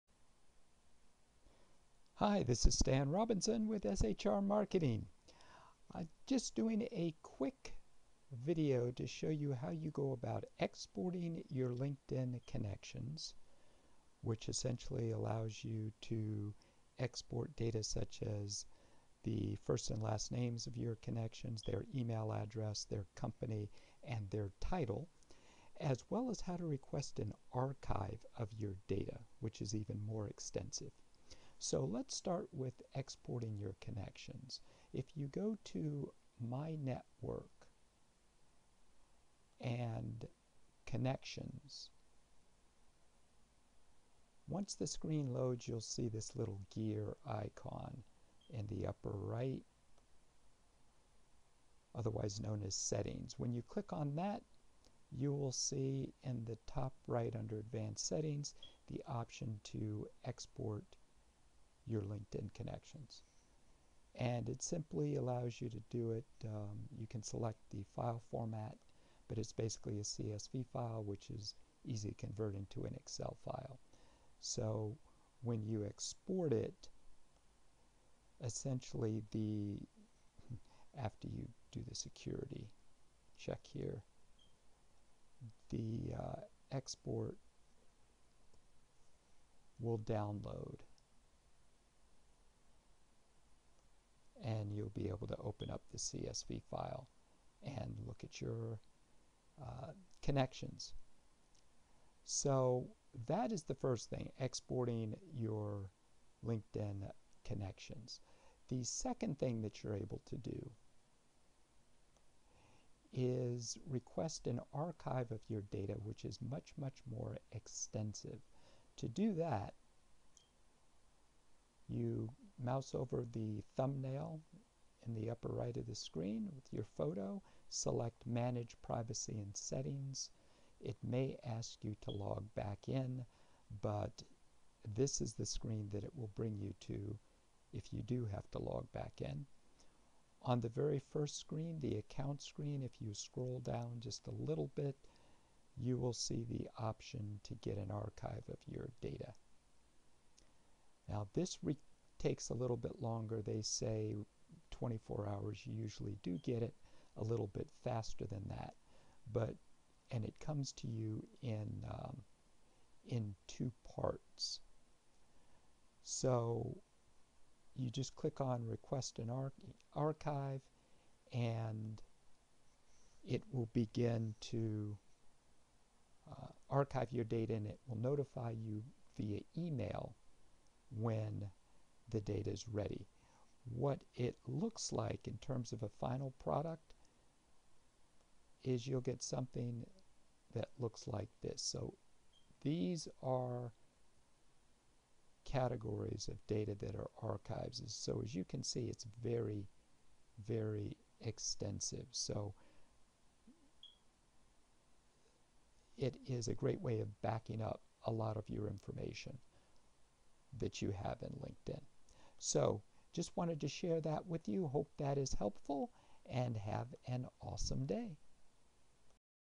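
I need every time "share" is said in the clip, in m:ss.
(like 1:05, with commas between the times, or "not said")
3:33.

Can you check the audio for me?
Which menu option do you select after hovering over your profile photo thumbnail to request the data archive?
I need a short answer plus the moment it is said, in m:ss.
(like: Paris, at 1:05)
Manage Privacy and Settings, at 2:08.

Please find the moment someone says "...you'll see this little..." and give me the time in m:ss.
0:45.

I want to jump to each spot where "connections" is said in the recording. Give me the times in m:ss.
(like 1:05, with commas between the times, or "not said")
0:12, 0:20, 0:33, 0:40, 1:02, 1:40, 1:47.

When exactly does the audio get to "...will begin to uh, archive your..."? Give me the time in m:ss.
2:53.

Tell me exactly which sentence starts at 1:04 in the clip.
And it simply allows you to do it.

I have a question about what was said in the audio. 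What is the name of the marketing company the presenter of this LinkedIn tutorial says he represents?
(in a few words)
SHR Marketing.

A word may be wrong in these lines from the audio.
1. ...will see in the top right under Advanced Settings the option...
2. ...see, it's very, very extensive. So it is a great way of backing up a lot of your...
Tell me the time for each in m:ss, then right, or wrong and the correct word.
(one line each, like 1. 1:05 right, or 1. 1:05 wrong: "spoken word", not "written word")
1. 0:55 right
2. 3:18 right.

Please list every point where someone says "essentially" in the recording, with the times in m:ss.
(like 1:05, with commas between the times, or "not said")
0:14, 1:18.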